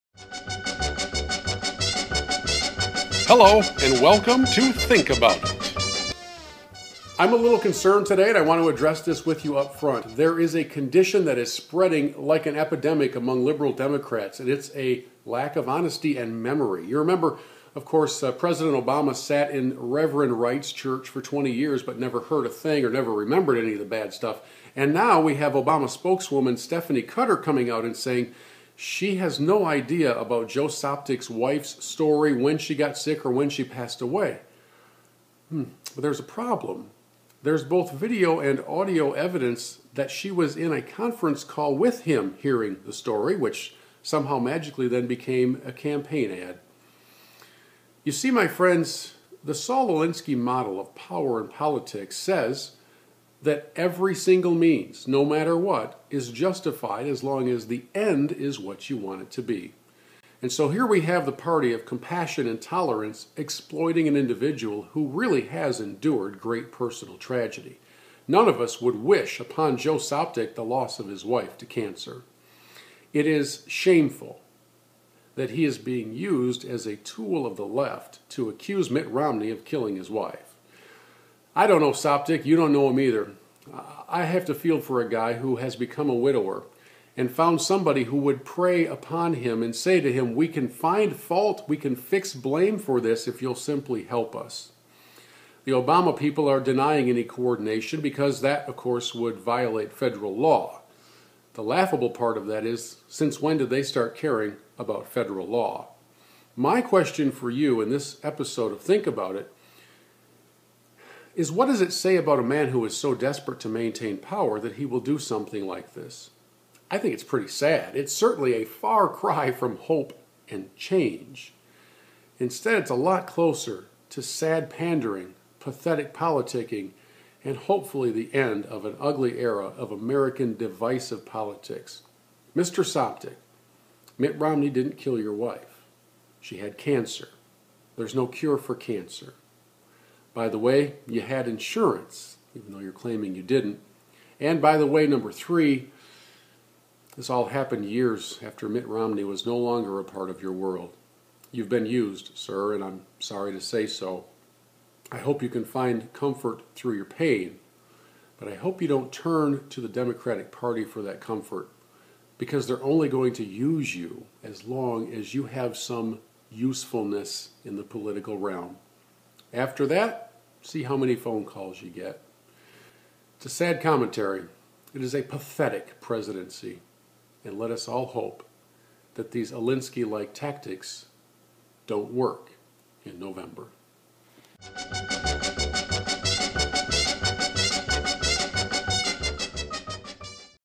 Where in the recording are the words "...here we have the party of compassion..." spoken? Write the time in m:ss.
1:00.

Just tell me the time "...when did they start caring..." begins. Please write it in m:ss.
1:43.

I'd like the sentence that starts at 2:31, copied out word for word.
You've been used, sir, and I'm sorry to say so.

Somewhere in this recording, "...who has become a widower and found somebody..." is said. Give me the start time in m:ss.
1:25.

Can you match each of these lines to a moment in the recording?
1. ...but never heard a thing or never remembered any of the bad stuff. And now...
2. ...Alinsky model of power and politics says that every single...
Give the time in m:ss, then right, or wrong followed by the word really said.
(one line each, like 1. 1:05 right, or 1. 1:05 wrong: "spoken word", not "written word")
1. 0:21 right
2. 0:49 right.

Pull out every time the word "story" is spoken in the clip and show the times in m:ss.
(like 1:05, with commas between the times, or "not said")
0:31, 0:42.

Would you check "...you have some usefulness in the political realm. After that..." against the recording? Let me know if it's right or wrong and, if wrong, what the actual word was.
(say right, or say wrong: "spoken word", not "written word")
right.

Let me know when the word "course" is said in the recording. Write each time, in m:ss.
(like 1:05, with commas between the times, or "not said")
0:17, 1:38.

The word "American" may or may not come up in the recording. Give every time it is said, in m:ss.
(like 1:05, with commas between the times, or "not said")
2:09.